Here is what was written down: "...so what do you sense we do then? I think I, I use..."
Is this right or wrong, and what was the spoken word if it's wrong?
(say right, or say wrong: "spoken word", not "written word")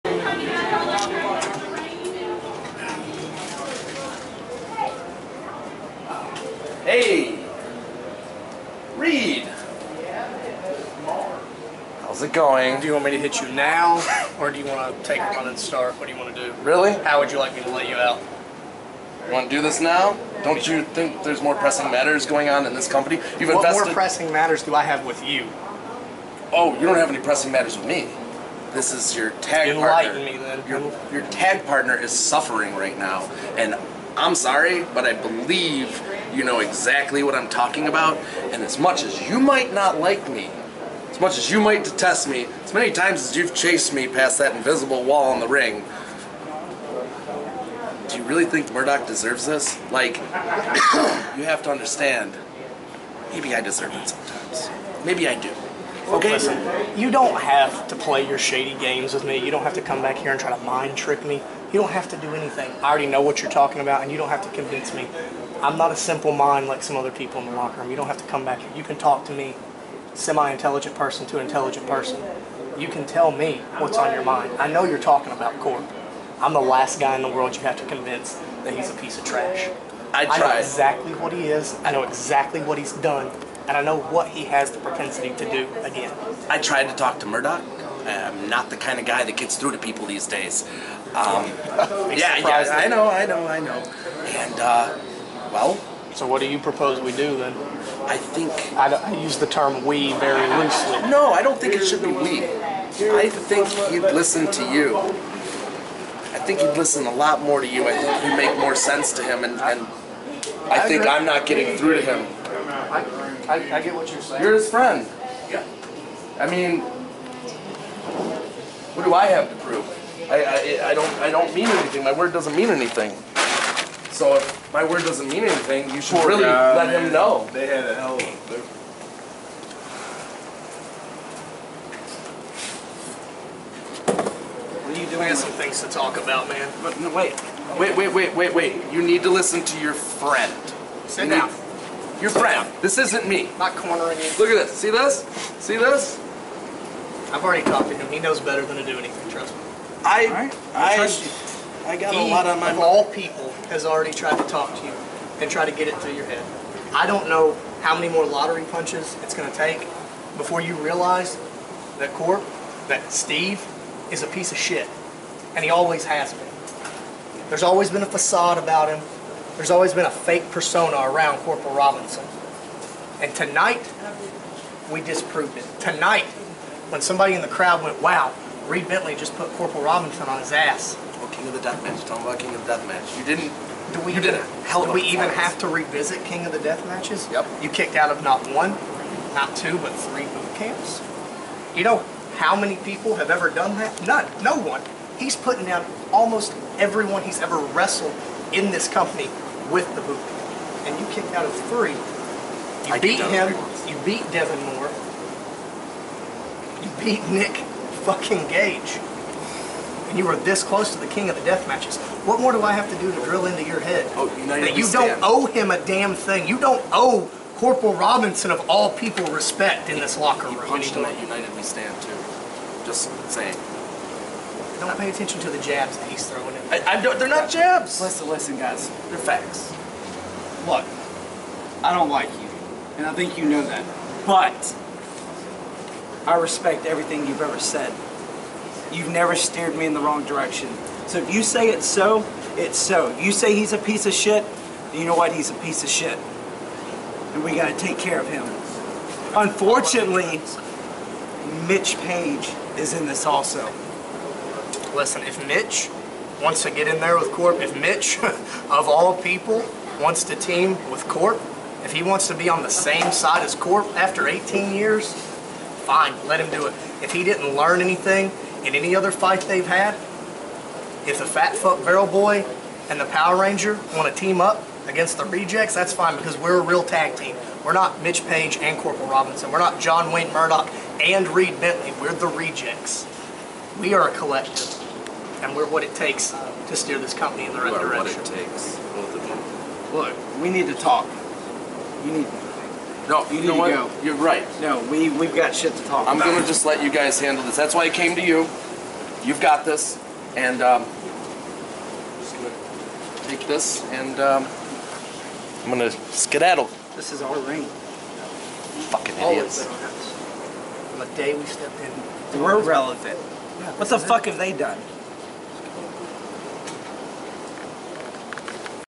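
wrong: "propose", not "sense".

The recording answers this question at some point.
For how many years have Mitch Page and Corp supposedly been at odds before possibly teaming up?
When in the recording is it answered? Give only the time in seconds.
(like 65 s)
264 s.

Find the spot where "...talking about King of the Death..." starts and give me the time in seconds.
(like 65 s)
182 s.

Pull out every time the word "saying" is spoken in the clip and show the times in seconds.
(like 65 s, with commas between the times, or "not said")
114 s, 223 s.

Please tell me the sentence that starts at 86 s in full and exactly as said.
I tried to talk to Murdoch.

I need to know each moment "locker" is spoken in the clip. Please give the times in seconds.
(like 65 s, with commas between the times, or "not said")
67 s, 220 s.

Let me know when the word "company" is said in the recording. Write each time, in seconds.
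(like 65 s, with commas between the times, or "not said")
22 s, 198 s, 287 s.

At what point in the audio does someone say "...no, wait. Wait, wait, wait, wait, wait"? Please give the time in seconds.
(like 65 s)
136 s.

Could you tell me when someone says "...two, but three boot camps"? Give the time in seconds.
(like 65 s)
189 s.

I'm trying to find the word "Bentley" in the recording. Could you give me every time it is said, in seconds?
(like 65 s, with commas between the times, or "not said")
178 s, 281 s.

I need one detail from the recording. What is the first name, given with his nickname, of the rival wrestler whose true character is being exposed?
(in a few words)
Steve.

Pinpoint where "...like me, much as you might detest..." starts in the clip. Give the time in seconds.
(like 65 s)
39 s.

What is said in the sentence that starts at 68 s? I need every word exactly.
You can talk to me semi-intelligent person to intelligent person.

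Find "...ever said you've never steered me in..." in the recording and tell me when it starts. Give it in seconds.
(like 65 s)
237 s.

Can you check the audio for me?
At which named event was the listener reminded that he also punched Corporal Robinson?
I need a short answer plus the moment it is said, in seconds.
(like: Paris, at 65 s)
United We Stand, at 221 s.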